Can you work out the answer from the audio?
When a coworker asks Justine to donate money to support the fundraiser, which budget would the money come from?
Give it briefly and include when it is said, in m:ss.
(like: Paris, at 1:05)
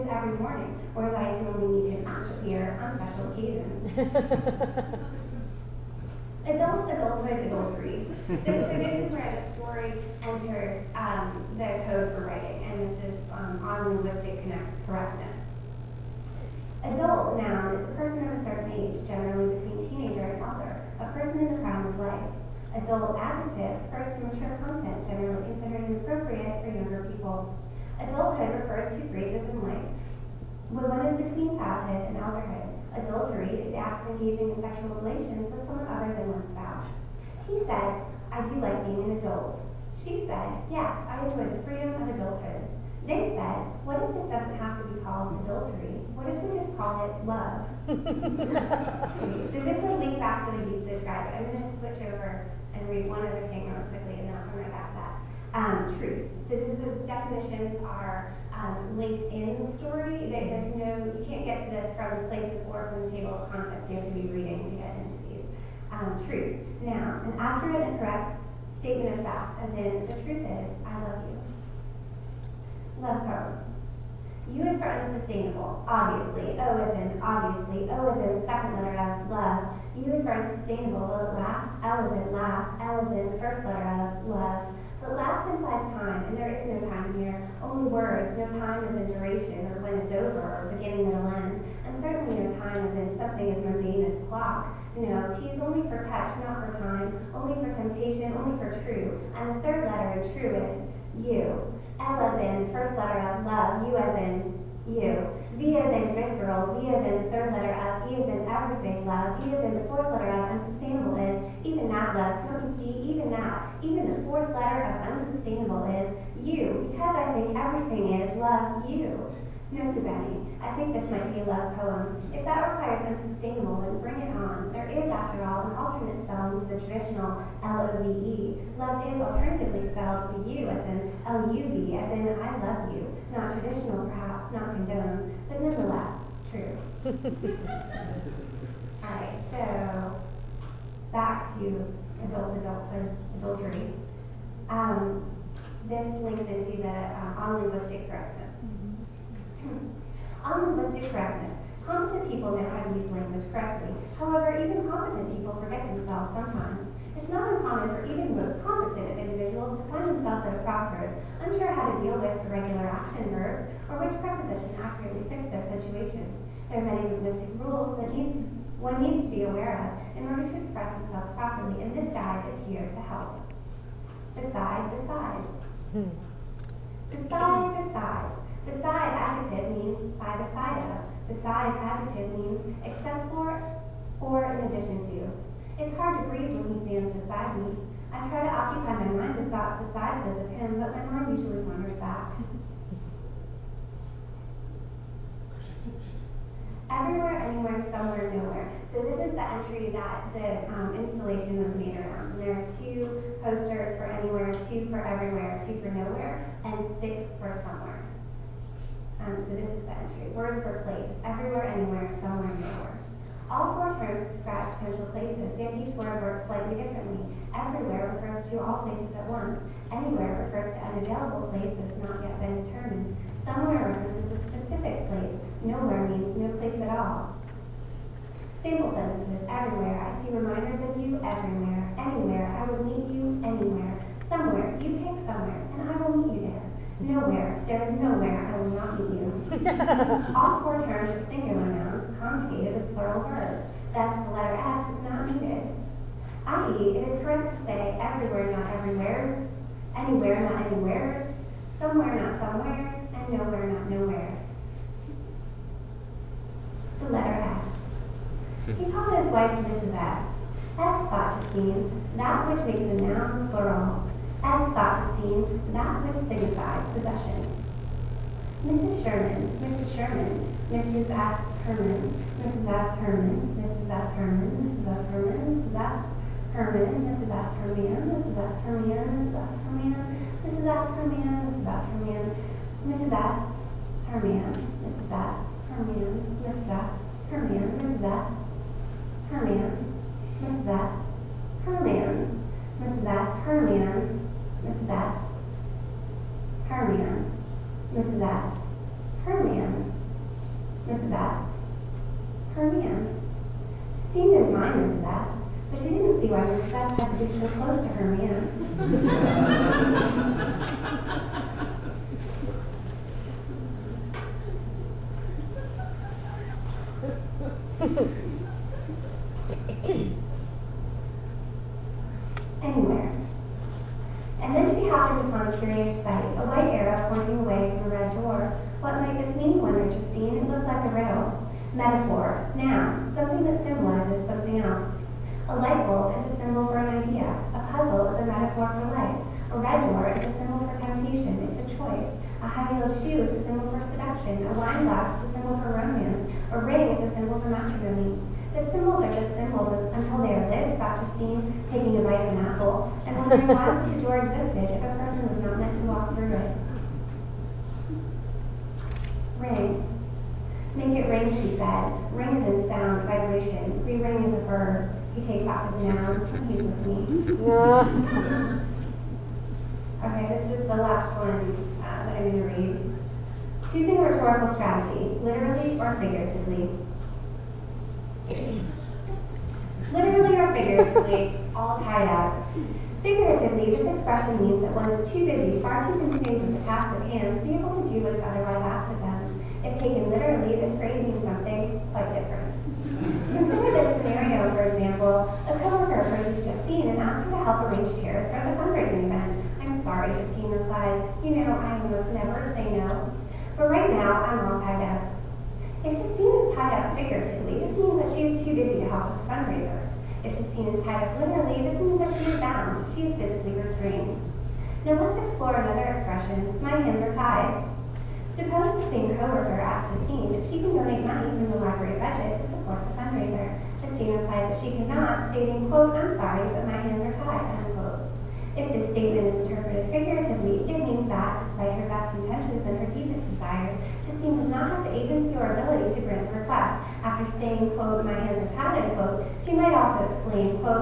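The library budget, at 7:01.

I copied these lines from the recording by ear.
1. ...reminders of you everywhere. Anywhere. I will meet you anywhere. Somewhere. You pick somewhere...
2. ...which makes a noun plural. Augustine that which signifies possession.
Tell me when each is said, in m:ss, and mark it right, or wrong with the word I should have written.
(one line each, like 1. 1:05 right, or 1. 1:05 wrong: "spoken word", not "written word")
1. 3:50 right
2. 4:22 right.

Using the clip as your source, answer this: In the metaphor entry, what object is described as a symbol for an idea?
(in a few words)
A light bulb.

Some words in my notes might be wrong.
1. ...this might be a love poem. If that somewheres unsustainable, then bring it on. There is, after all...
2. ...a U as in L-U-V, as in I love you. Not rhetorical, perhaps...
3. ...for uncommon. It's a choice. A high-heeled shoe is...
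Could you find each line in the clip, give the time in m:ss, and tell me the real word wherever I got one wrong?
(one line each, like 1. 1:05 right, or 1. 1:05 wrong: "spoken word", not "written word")
1. 2:00 wrong: "requires", not "somewheres"
2. 2:10 wrong: "traditional", not "rhetorical"
3. 5:40 wrong: "temptation", not "uncommon".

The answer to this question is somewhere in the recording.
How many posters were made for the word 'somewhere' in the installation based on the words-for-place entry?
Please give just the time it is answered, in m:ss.
3:26.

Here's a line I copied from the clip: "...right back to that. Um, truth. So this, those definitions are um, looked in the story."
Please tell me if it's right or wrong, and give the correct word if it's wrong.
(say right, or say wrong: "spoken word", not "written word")
wrong: "linked", not "looked".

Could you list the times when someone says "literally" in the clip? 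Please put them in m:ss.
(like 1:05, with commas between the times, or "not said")
6:15, 6:19, 6:30, 6:51.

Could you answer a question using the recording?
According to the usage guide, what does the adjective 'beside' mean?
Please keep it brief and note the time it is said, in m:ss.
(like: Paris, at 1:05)
By the side of, at 3:00.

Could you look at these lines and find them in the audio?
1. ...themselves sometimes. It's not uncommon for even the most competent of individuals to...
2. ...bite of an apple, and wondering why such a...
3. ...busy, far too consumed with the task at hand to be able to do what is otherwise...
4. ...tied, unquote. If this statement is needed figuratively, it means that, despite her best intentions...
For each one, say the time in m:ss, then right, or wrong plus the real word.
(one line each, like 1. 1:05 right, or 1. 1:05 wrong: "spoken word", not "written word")
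1. 2:35 right
2. 5:52 right
3. 6:25 right
4. 7:07 wrong: "interpreted", not "needed".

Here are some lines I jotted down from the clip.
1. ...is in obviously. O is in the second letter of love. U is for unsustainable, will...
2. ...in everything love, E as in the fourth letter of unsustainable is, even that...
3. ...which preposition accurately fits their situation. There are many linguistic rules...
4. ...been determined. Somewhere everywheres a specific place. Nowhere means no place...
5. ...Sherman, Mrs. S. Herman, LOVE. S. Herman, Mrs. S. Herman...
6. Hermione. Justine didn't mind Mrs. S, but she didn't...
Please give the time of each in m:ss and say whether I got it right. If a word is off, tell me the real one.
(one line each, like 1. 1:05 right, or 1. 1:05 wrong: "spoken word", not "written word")
1. 1:16 right
2. 1:48 right
3. 2:43 right
4. 3:42 wrong: "references", not "everywheres"
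5. 4:29 wrong: "Mrs", not "LOVE"
6. 5:02 right.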